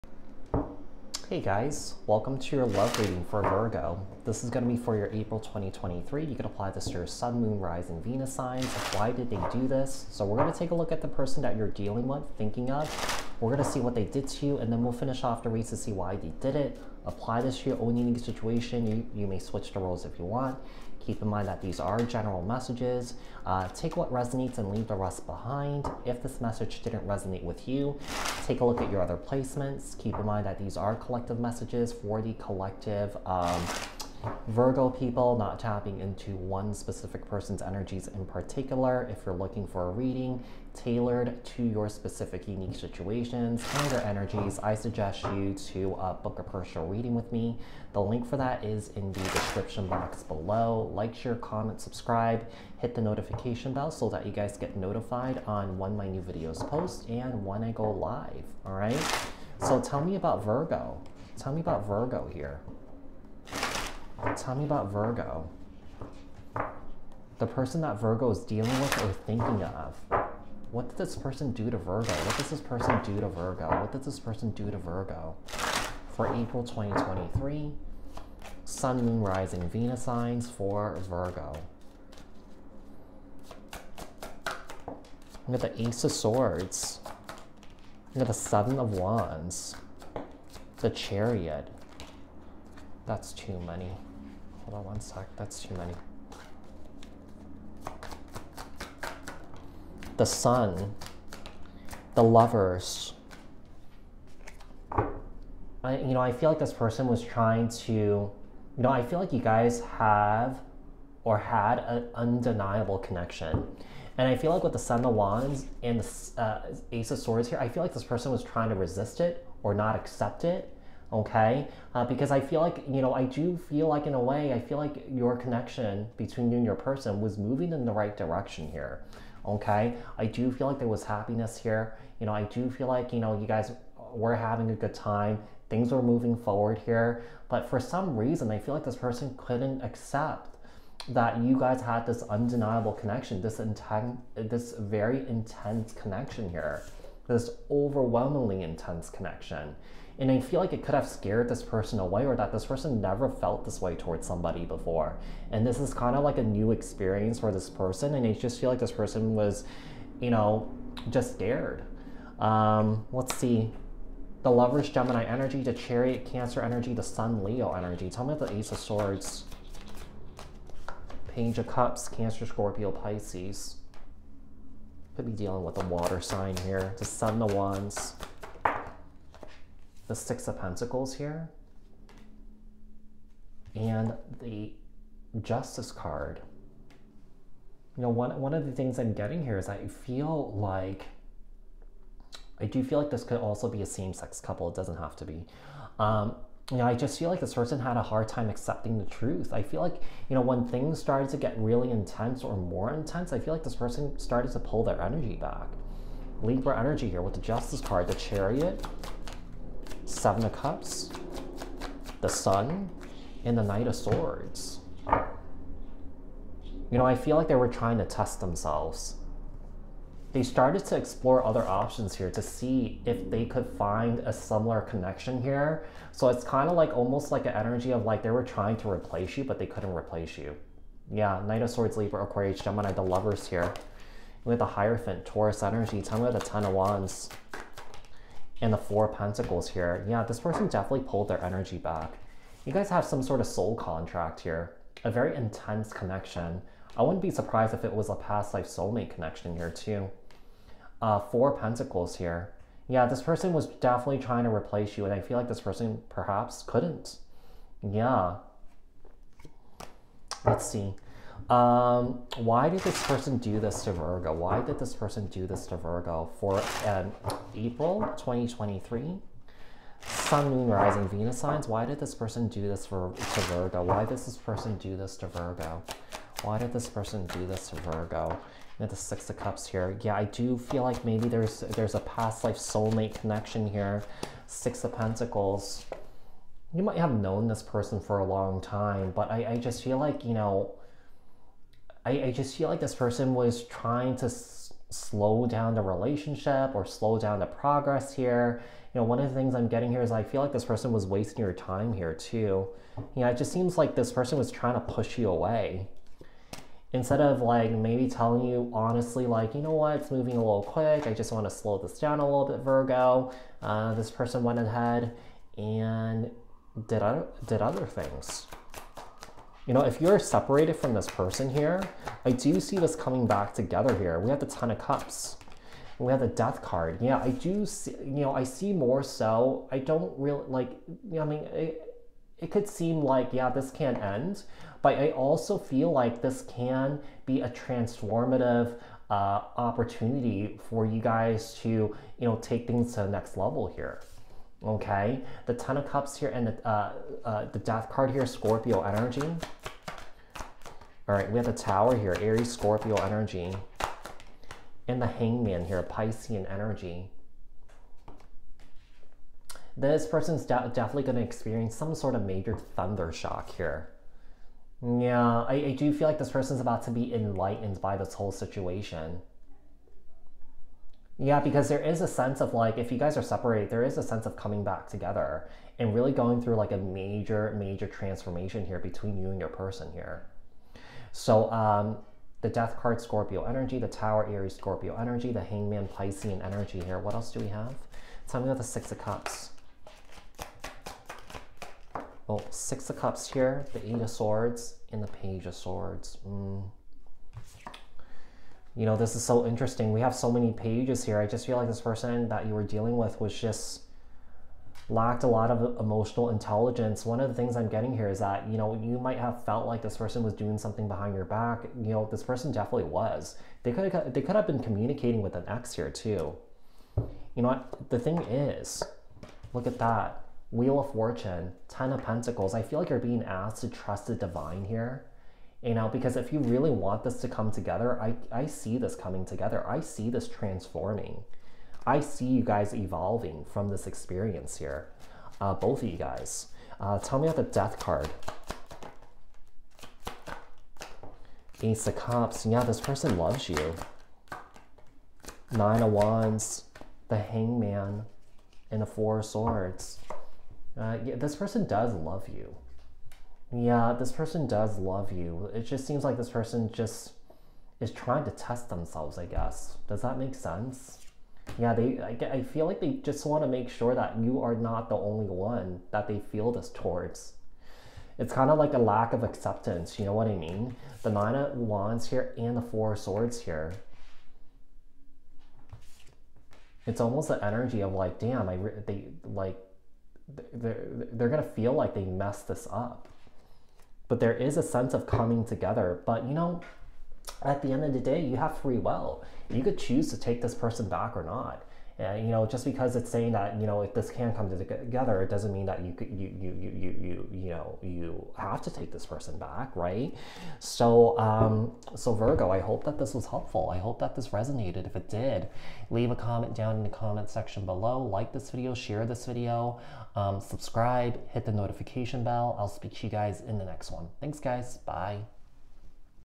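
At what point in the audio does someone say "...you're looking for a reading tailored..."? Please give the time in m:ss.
0:39.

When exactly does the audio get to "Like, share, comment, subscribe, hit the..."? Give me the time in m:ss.
0:50.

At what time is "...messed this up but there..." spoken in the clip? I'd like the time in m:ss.
8:02.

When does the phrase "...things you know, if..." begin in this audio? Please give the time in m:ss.
5:17.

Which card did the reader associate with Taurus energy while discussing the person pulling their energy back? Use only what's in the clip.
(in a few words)
The Hierophant.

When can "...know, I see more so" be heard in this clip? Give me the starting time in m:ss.
5:28.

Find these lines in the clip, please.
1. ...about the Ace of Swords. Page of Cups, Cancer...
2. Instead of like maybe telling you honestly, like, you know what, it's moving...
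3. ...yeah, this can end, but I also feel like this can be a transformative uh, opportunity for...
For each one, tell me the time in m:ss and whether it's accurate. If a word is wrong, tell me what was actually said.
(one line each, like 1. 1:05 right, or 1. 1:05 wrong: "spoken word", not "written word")
1. 2:48 right
2. 5:06 right
3. 5:33 right.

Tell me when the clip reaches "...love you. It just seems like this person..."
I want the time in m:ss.
7:34.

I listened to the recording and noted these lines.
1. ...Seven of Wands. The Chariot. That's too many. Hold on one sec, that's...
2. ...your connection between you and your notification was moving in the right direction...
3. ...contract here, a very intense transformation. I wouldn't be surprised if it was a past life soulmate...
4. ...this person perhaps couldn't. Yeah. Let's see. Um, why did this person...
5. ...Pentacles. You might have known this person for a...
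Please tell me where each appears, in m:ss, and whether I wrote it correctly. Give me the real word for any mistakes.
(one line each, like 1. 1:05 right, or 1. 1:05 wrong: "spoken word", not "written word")
1. 1:28 right
2. 2:05 wrong: "person", not "notification"
3. 4:03 wrong: "connection", not "transformation"
4. 4:15 right
5. 4:44 right.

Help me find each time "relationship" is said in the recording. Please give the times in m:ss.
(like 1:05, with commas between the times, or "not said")
4:55.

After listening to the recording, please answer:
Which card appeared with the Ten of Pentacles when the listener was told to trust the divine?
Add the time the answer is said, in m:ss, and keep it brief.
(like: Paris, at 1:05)
Wheel of Fortune, at 7:00.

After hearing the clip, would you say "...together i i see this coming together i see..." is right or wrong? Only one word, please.
right.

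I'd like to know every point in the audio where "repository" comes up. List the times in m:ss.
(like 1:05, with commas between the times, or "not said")
not said.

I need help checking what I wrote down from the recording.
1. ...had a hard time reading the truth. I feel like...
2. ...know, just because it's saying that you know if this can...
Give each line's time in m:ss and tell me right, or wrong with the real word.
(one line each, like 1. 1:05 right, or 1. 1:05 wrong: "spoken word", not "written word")
1. 3:17 wrong: "accepting", not "reading"
2. 8:12 right.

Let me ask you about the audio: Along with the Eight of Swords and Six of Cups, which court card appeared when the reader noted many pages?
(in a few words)
Page of Swords.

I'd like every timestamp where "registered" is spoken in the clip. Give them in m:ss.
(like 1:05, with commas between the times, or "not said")
not said.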